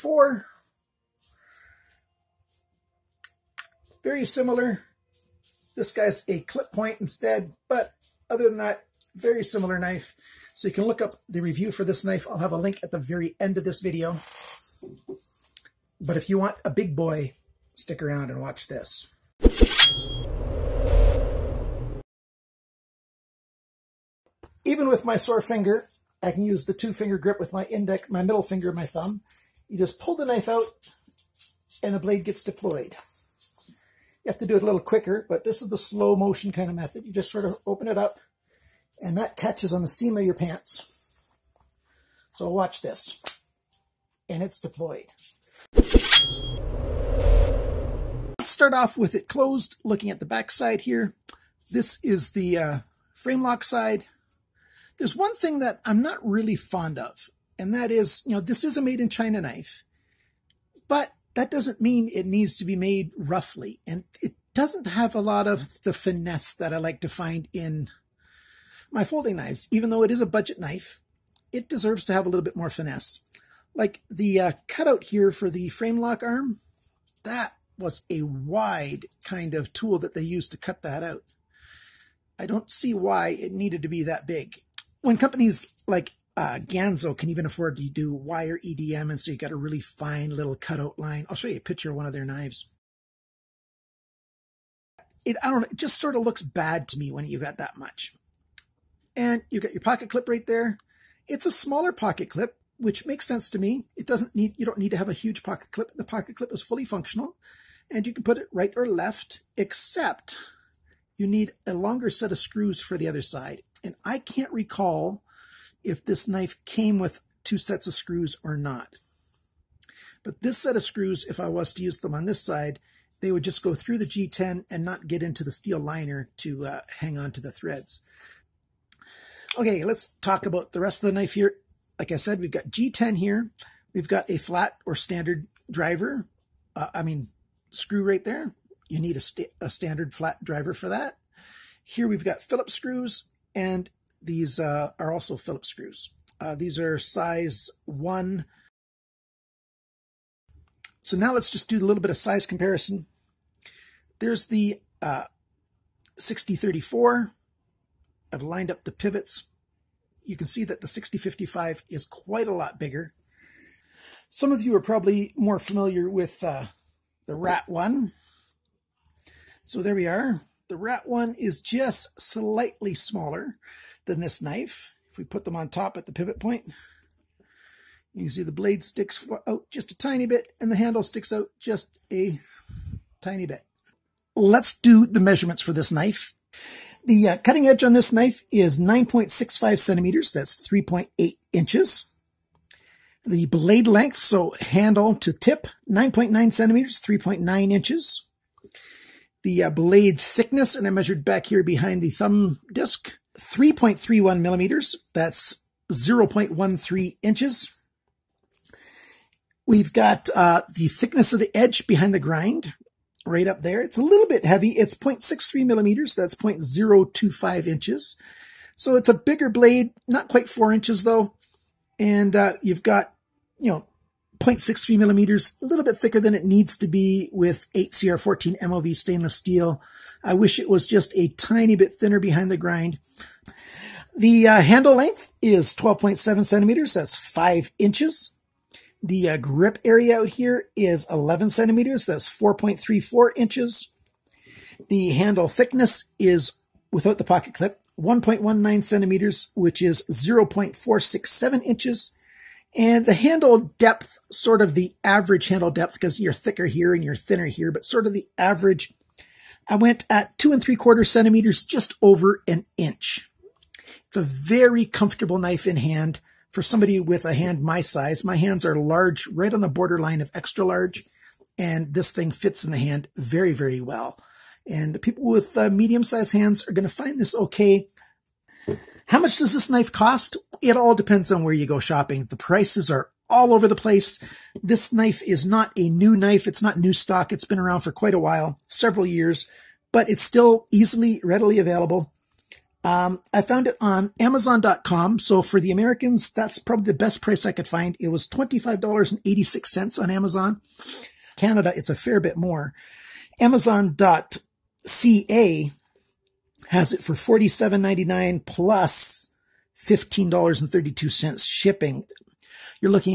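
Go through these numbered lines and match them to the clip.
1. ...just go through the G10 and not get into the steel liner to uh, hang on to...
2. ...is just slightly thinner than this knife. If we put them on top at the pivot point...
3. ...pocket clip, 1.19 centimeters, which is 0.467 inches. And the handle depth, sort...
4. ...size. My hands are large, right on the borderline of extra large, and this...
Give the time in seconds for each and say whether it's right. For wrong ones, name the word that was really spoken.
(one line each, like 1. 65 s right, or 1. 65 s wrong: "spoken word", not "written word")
1. 123 s right
2. 171 s wrong: "smaller", not "thinner"
3. 247 s right
4. 267 s right.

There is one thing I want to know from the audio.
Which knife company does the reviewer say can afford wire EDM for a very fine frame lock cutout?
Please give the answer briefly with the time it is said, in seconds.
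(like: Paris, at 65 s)
Ganzo, at 86 s.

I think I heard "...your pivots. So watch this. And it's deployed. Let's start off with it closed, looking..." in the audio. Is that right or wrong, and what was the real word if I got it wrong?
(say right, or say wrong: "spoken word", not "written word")
wrong: "pants", not "pivots".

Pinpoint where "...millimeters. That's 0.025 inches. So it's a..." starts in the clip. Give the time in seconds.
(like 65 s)
215 s.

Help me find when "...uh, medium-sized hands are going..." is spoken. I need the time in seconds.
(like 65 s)
275 s.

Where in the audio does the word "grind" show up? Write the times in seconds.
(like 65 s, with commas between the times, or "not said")
212 s, 232 s.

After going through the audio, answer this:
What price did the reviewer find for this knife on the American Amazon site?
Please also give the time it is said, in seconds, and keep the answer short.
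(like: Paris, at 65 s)
$25.86, at 298 s.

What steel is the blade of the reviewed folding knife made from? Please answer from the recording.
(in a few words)
8CR14 MOV.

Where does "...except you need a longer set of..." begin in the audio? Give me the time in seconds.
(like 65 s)
109 s.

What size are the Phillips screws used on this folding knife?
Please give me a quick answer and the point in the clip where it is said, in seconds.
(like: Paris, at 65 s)
Size 1, at 146 s.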